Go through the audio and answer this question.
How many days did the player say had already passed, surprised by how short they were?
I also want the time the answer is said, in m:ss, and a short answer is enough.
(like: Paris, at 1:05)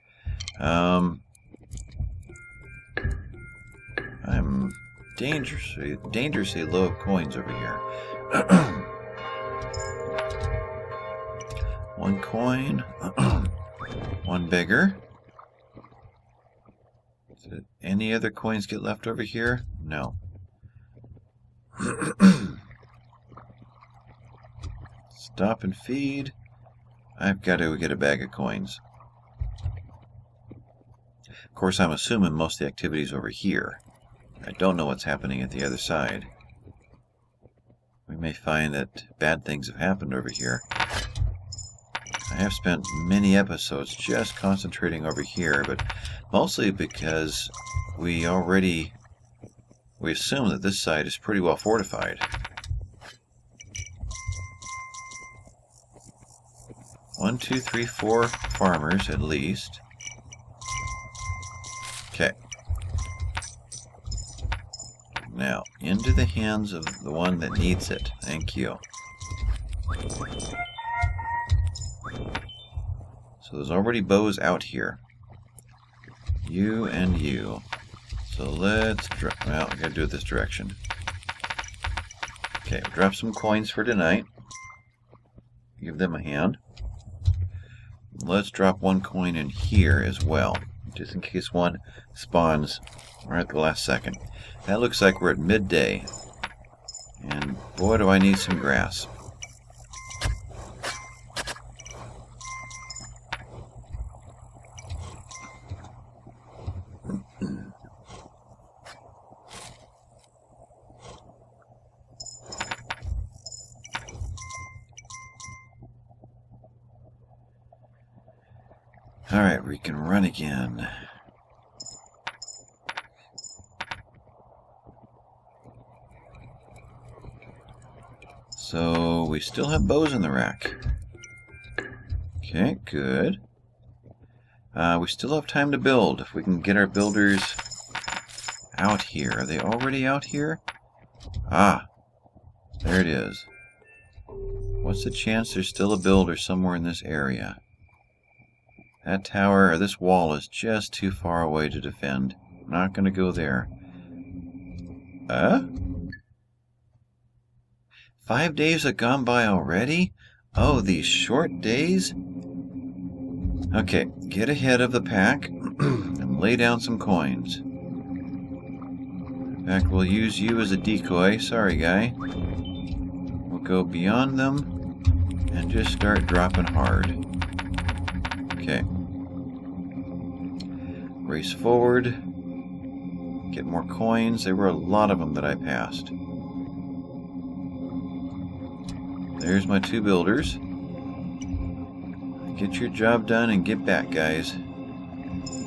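5, at 2:38.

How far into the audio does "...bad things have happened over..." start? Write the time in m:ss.
0:39.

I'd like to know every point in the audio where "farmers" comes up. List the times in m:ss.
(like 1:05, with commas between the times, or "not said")
0:58.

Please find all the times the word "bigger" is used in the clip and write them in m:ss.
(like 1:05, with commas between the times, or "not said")
0:14.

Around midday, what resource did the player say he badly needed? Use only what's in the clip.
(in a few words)
grass.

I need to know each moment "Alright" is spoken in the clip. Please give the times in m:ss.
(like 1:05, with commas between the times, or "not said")
1:59.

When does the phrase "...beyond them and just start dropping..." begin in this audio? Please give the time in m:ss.
2:53.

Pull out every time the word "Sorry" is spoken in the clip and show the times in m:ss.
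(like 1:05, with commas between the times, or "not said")
2:51.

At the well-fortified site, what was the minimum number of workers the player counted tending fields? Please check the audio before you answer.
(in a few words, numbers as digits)
4.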